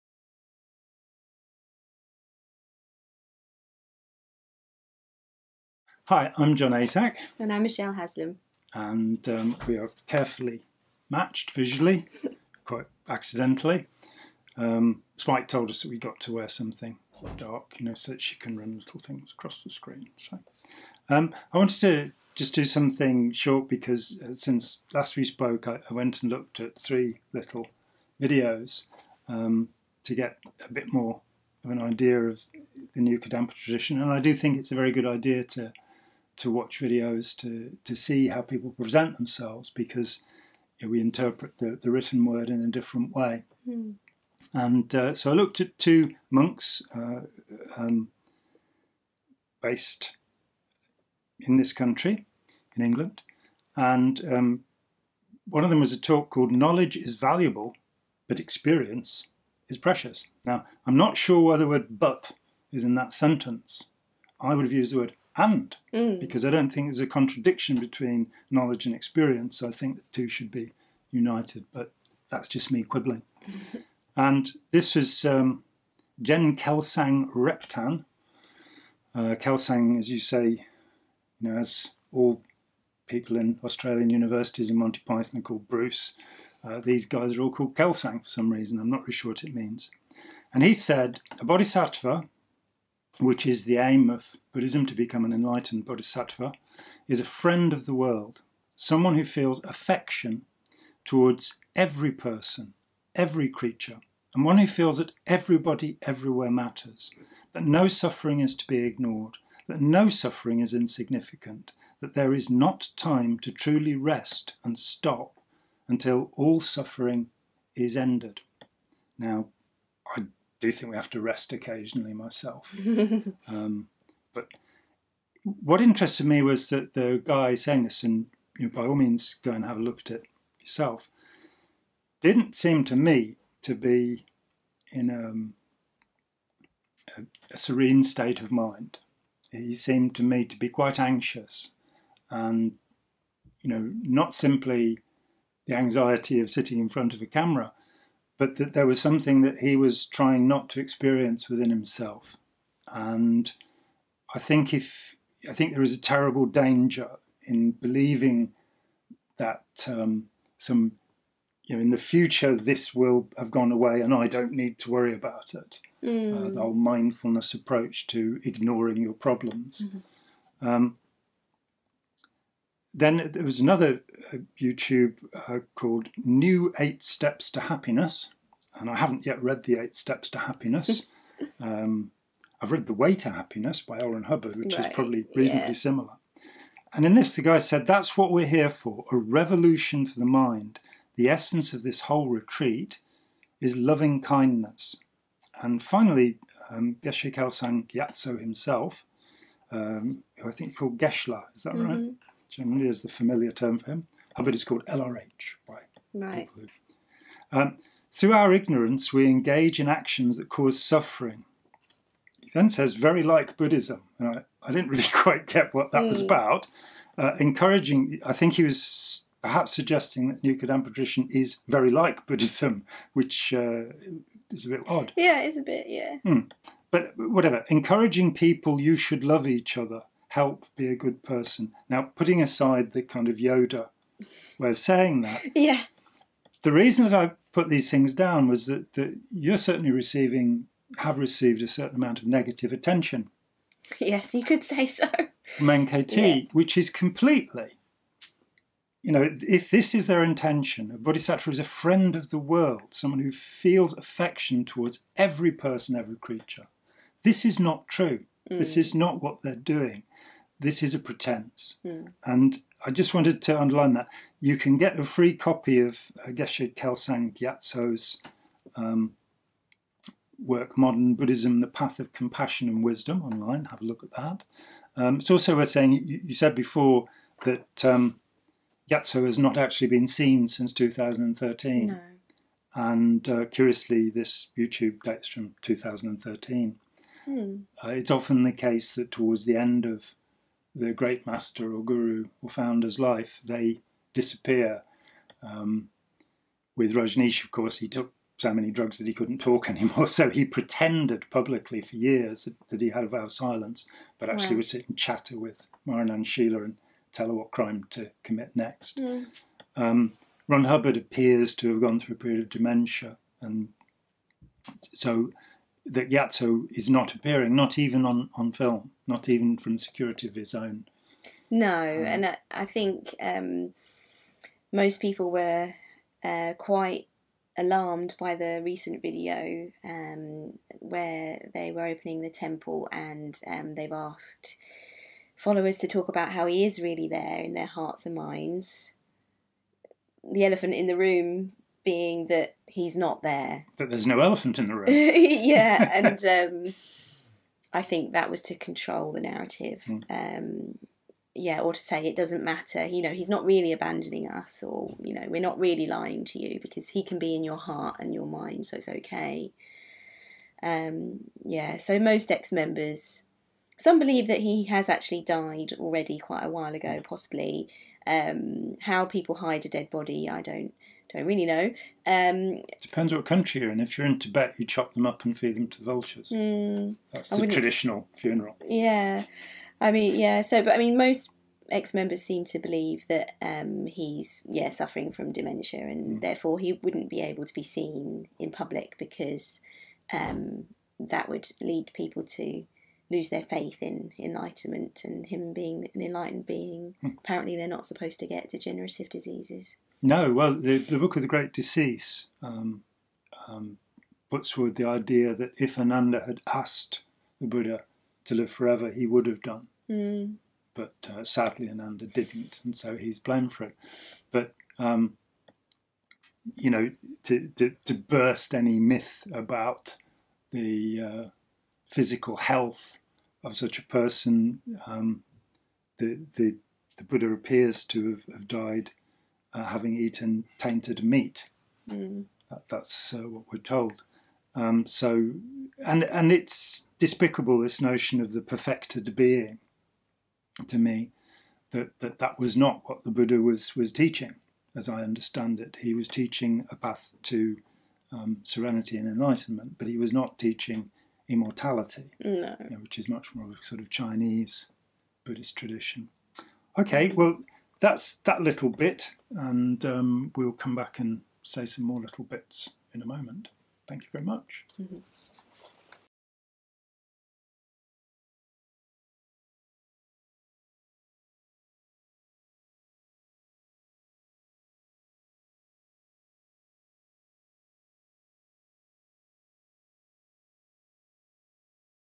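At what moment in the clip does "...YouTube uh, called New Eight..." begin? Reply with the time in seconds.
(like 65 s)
174 s.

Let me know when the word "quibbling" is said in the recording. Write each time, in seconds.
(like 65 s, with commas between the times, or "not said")
72 s.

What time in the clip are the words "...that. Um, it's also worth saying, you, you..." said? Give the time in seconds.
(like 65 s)
274 s.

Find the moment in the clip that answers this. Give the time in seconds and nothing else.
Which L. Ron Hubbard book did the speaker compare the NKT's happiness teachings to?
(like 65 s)
182 s.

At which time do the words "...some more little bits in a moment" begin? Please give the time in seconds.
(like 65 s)
461 s.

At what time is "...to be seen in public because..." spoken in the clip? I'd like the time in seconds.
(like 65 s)
387 s.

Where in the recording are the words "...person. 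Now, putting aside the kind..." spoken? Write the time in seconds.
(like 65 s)
231 s.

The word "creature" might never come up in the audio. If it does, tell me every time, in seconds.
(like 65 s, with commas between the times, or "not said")
103 s, 256 s.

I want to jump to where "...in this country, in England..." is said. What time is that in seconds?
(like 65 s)
51 s.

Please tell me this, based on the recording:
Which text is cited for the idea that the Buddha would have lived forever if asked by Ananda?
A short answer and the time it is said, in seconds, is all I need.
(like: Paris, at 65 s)
the Book of the Great Decease, at 400 s.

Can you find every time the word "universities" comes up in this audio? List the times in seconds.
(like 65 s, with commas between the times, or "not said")
84 s.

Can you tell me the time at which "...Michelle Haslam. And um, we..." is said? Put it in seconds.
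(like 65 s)
7 s.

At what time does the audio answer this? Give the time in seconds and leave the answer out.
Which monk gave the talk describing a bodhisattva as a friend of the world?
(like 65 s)
76 s.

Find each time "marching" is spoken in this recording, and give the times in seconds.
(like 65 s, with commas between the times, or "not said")
not said.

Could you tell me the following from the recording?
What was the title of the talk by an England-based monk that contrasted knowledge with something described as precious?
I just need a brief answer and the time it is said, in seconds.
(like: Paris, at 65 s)
Knowledge is Valuable, but Experience is Precious, at 56 s.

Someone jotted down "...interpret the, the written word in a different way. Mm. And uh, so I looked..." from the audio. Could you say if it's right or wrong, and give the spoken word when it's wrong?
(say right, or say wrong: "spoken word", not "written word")
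right.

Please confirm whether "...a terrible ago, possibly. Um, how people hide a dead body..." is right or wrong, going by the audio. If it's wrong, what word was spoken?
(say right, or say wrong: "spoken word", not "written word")
wrong: "while", not "terrible".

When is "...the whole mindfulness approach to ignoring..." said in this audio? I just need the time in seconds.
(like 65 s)
166 s.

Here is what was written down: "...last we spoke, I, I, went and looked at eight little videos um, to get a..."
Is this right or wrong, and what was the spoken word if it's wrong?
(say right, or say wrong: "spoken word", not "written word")
wrong: "three", not "eight".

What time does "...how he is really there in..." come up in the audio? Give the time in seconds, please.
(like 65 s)
336 s.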